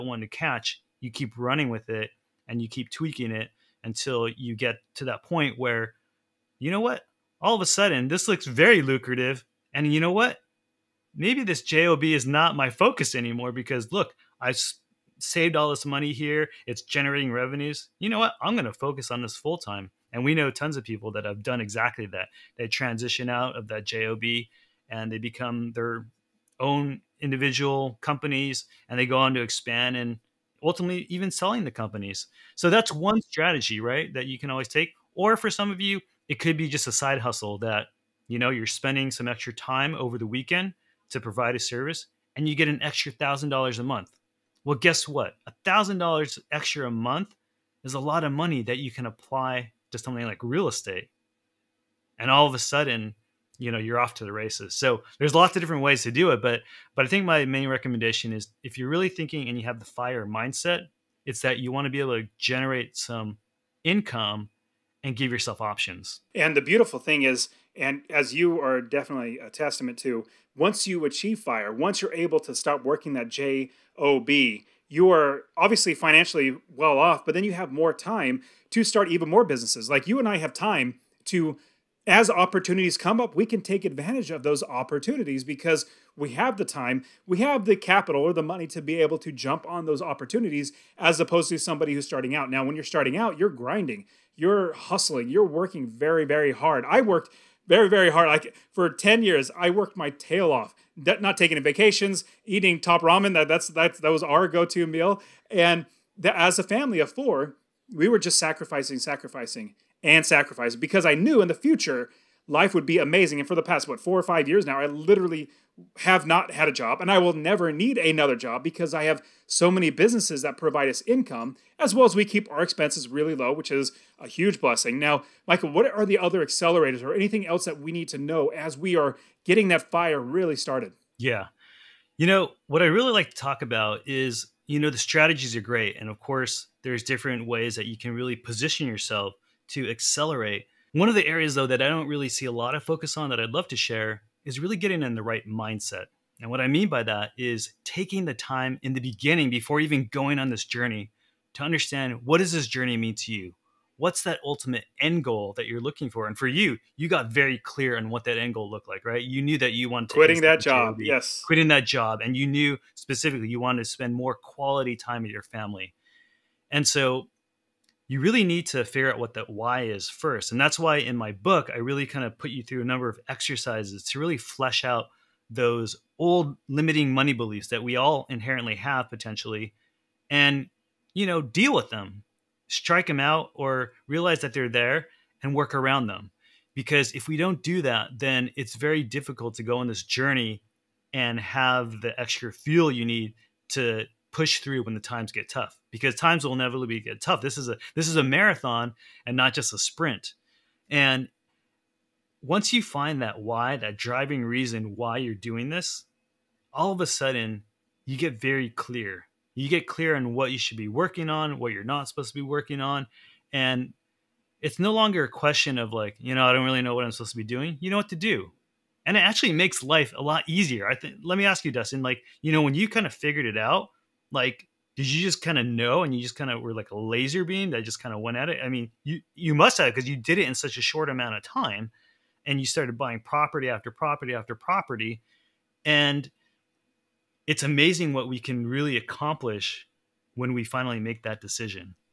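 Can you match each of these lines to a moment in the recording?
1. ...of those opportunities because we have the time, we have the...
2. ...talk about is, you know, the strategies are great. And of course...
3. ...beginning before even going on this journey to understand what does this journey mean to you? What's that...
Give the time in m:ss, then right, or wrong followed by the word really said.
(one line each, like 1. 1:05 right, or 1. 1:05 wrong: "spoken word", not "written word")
1. 1:24 right
2. 2:13 right
3. 2:28 right.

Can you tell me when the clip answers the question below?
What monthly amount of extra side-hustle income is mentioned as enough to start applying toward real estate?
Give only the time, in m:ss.
0:42.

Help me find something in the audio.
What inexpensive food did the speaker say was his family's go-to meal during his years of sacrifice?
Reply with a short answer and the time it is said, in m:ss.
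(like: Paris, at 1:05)
Top ramen, at 1:42.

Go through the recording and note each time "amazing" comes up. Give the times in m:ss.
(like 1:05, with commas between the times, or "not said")
1:52, 3:57.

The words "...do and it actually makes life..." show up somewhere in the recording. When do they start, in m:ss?
3:38.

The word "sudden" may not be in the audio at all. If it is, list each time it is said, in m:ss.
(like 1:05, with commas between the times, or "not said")
0:07, 0:52, 3:27.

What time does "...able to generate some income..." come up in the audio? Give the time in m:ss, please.
1:01.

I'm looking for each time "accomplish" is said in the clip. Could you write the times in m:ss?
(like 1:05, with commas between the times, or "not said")
3:58.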